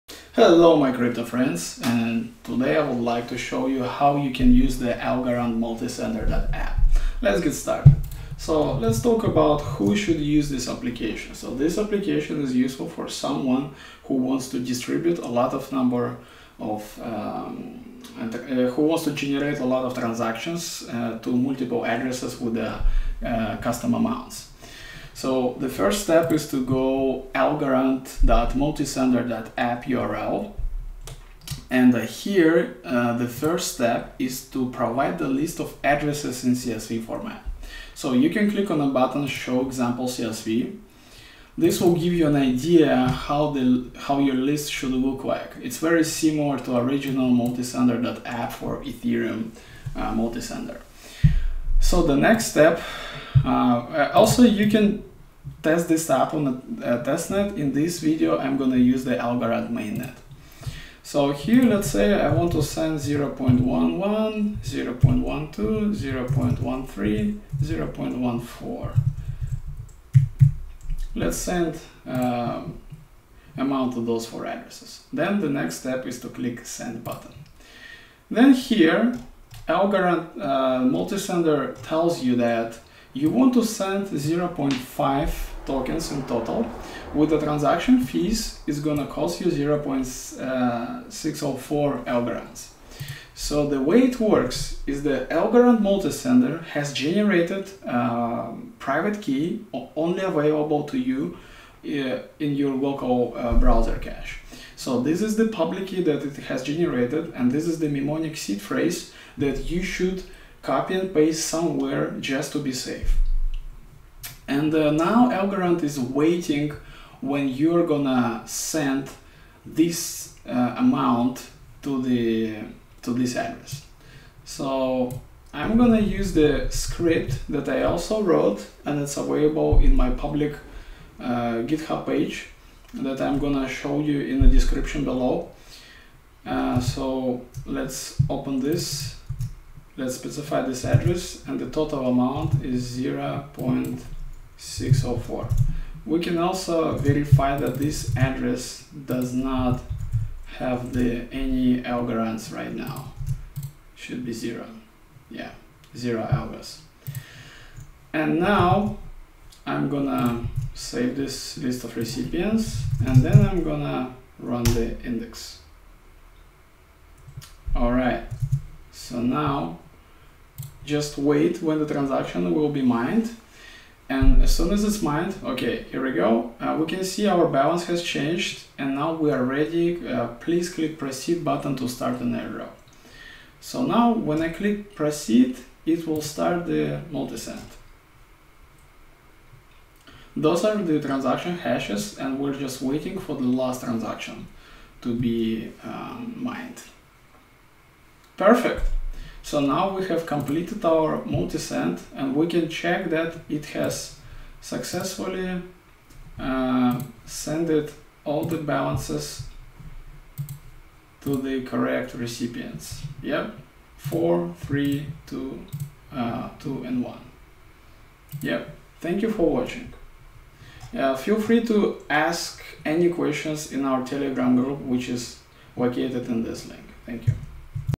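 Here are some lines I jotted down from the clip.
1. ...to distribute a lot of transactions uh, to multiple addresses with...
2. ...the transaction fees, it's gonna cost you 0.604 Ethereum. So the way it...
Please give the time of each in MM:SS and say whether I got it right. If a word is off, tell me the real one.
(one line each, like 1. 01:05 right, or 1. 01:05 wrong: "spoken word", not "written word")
1. 00:19 wrong: "generate", not "distribute"
2. 01:27 wrong: "Algorand", not "Ethereum".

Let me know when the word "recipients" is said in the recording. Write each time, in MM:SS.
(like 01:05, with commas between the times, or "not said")
02:41, 03:32.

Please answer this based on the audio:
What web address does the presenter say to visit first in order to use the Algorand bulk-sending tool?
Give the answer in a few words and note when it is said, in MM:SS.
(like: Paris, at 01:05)
algorand.multisender.app, at 00:27.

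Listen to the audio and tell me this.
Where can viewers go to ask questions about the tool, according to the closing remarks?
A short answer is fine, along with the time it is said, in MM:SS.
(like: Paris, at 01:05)
Telegram group, at 03:44.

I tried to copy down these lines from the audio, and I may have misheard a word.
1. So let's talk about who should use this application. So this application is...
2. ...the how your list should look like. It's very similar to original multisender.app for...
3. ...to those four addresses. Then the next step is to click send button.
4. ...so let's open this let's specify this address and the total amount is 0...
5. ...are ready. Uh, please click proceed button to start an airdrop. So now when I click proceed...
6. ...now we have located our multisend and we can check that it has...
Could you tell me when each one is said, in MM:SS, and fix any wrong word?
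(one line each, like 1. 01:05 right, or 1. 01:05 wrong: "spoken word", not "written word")
1. 00:08 right
2. 00:43 right
3. 01:13 right
4. 02:16 right
5. 02:59 right
6. 03:19 wrong: "completed", not "located".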